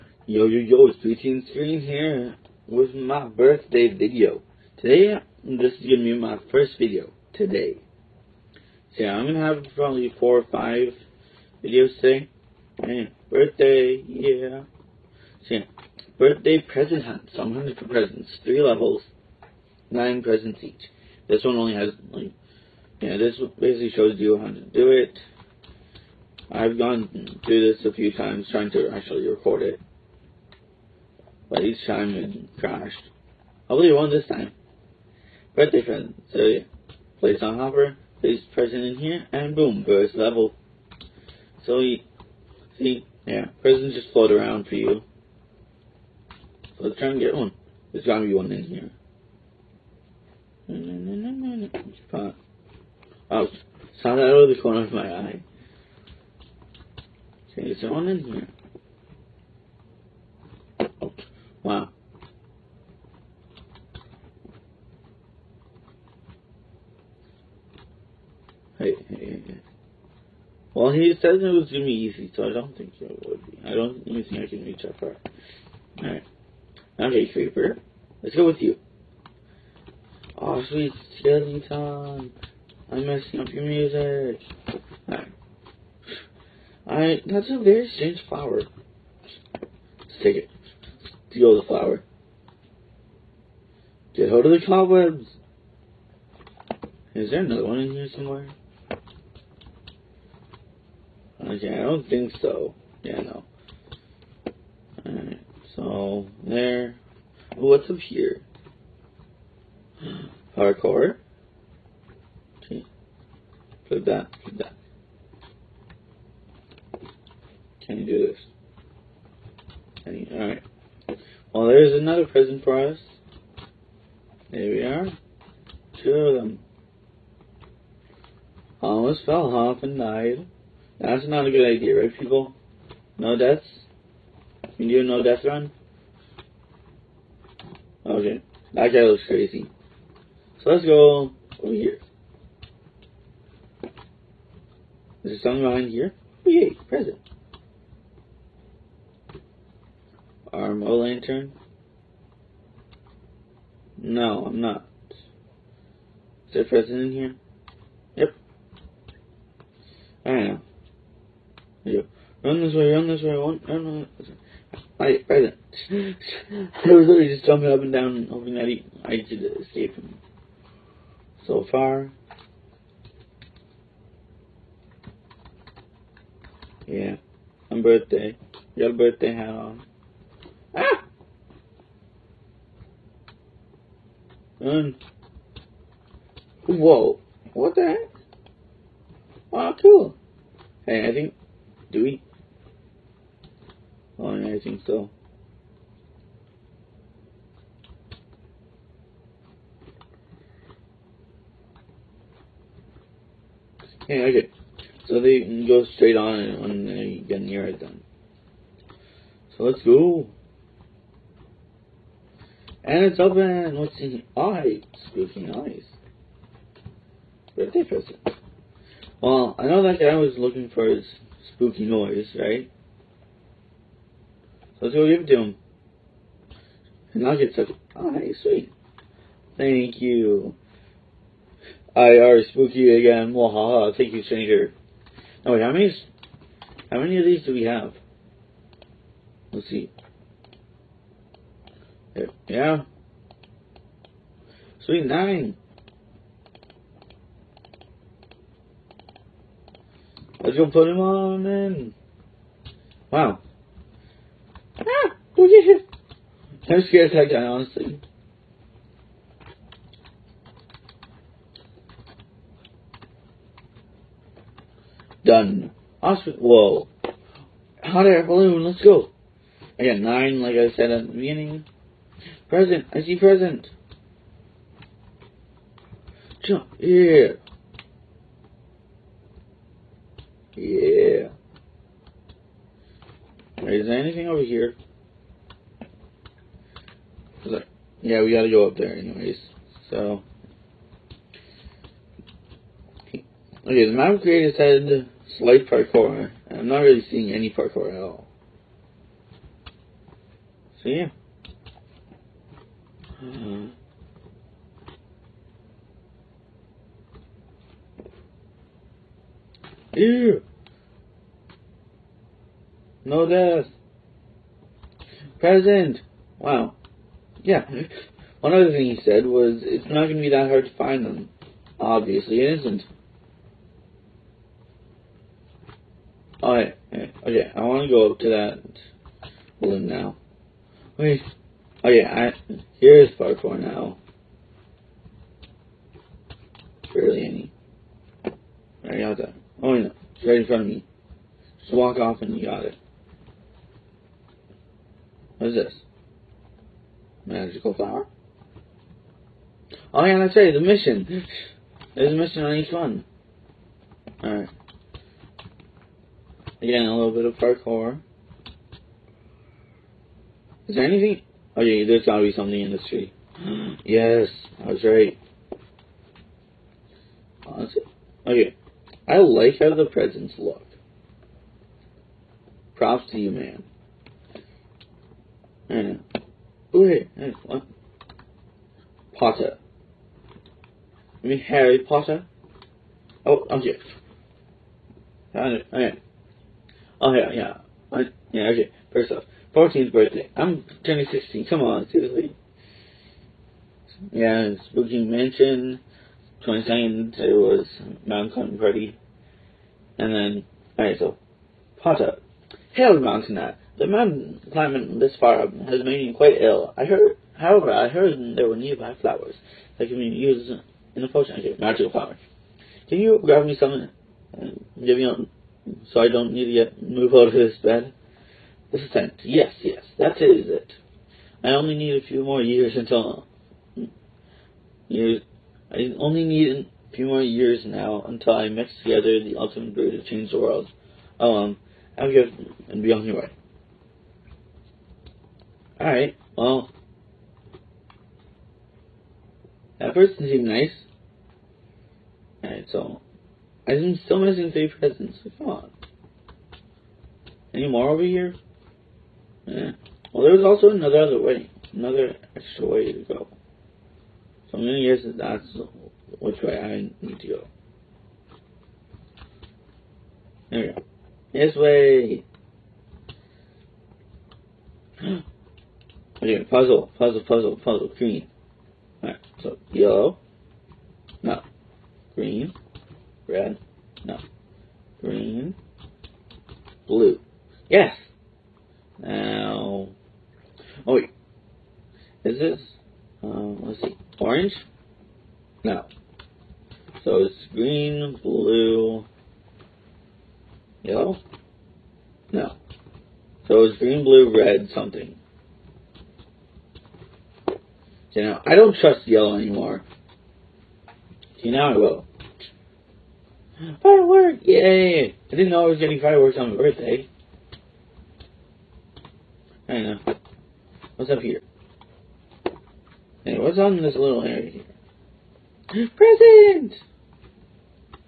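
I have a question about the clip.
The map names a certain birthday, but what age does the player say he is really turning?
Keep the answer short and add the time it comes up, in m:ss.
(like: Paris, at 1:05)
16, at 6:30.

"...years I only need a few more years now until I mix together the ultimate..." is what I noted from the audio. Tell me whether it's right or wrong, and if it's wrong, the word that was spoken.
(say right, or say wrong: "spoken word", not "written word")
right.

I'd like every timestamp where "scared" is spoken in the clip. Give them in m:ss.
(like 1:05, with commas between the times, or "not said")
4:16.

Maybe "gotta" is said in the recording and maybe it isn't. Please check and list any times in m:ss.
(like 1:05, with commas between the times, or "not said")
0:48, 4:48, 6:02.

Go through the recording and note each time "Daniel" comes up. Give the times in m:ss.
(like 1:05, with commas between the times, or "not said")
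not said.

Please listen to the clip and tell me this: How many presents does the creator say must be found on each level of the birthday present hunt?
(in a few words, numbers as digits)
9.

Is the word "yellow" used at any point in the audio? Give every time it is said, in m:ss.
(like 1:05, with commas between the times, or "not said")
7:49, 8:10, 8:19.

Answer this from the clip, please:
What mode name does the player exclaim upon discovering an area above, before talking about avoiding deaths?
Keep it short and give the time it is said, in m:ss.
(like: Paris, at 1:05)
Hardcore, at 1:50.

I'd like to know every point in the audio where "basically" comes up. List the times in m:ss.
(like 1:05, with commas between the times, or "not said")
0:23.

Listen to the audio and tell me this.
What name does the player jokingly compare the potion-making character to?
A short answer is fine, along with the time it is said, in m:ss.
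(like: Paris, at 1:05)
Harry Potter, at 6:21.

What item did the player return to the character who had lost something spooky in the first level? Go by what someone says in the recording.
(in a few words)
Spooky eyes.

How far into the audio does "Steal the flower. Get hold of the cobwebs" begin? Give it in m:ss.
1:31.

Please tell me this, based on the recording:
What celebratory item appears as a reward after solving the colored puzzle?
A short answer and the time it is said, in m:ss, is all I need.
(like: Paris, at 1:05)
Firework, at 8:23.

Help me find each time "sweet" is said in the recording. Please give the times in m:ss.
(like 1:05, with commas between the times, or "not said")
1:20, 3:48, 4:04.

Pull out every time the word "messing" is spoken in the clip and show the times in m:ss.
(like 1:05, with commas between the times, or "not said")
1:23.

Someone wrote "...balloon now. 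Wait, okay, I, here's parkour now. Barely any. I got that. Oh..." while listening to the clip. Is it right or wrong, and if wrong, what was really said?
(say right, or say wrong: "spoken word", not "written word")
right.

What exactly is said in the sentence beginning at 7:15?
Alright, well, that person seemed nice.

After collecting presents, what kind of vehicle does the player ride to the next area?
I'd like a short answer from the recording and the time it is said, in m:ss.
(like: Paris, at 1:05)
Hot air balloon, at 4:27.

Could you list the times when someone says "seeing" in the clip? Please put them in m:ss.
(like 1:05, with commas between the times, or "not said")
4:57.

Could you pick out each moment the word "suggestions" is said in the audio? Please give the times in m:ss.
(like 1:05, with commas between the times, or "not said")
not said.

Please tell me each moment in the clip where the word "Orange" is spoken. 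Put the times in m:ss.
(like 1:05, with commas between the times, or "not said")
8:04.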